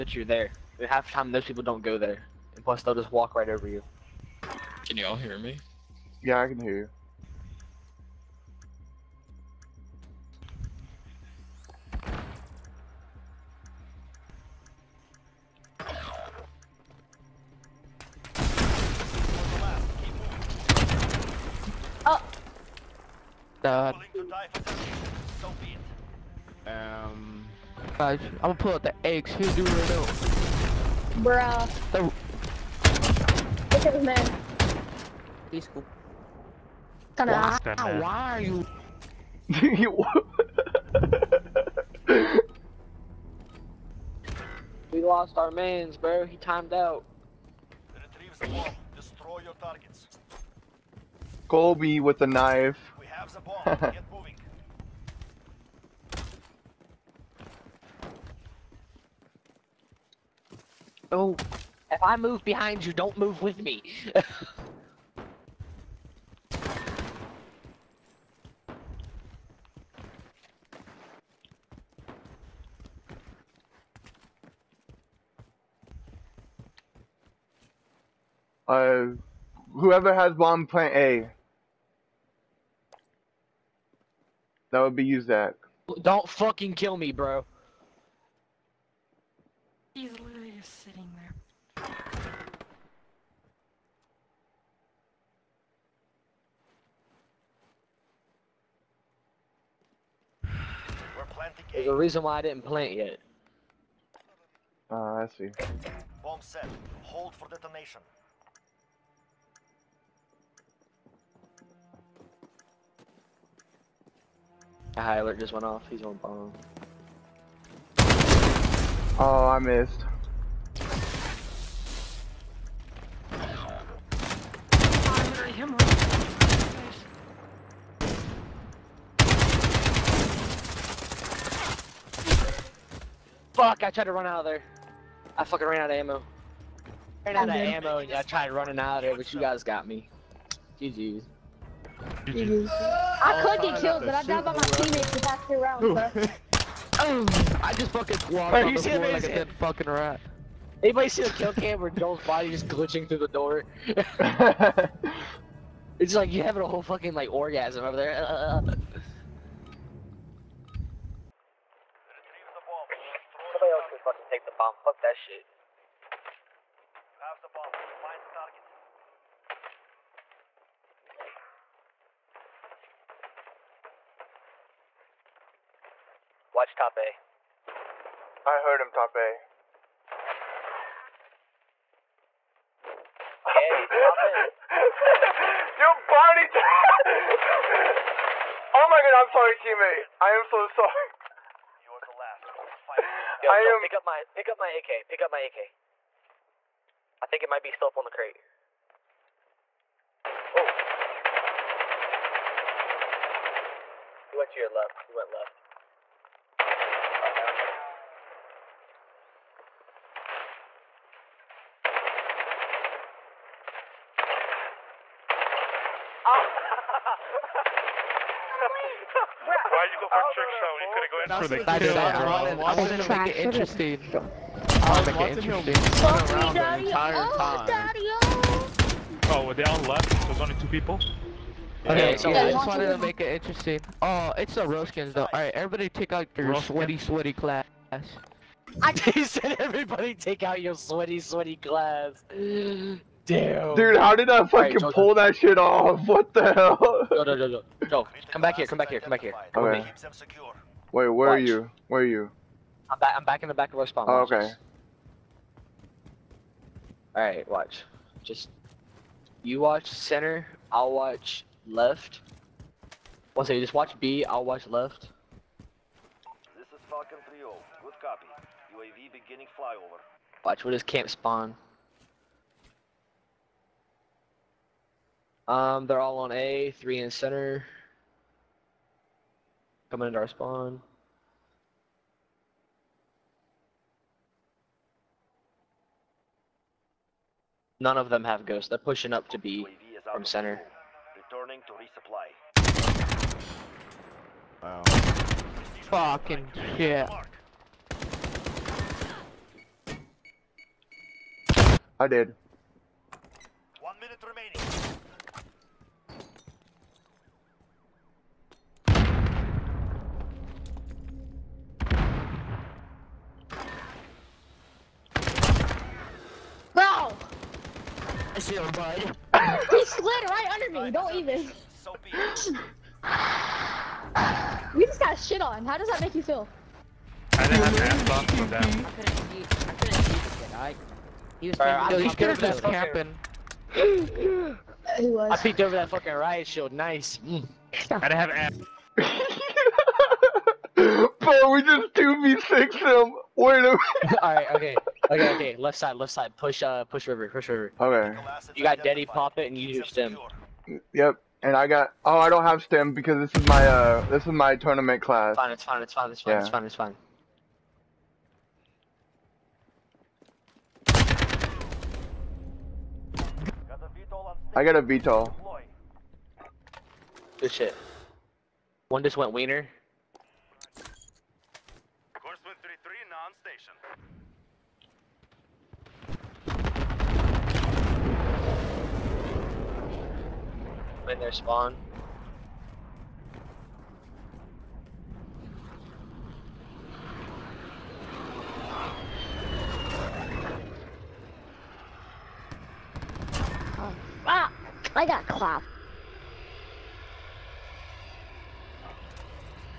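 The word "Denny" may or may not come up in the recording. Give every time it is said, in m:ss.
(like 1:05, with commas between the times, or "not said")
5:48.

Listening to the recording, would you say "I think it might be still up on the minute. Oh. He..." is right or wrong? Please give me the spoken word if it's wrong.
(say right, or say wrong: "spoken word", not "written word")
wrong: "crate", not "minute".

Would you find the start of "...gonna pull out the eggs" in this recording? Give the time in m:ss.
0:28.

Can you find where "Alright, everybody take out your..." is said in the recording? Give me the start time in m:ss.
3:55.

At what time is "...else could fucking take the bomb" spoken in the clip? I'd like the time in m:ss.
2:43.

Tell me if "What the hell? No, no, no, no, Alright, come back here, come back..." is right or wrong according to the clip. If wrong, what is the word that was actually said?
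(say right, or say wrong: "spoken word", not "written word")
wrong: "Joe", not "Alright".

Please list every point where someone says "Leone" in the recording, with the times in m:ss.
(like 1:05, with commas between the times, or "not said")
not said.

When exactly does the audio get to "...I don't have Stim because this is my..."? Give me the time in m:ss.
5:52.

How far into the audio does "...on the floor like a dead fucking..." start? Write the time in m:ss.
2:28.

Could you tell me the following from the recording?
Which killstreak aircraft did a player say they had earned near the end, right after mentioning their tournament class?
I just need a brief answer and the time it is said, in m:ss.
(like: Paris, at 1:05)
VTOL, at 6:04.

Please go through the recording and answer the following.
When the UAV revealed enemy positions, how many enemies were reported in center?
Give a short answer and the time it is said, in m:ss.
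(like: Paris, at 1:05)
3, at 4:36.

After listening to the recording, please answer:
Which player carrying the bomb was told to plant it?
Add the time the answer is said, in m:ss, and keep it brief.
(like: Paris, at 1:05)
Zach, at 1:24.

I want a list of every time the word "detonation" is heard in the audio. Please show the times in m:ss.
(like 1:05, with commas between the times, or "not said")
1:47.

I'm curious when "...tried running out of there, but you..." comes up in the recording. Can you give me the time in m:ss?
2:18.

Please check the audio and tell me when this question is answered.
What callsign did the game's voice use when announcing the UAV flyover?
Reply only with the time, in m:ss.
4:26.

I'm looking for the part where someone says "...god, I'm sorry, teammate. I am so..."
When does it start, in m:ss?
3:09.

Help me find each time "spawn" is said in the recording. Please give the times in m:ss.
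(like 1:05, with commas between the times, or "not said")
4:13, 4:31, 4:40, 6:21.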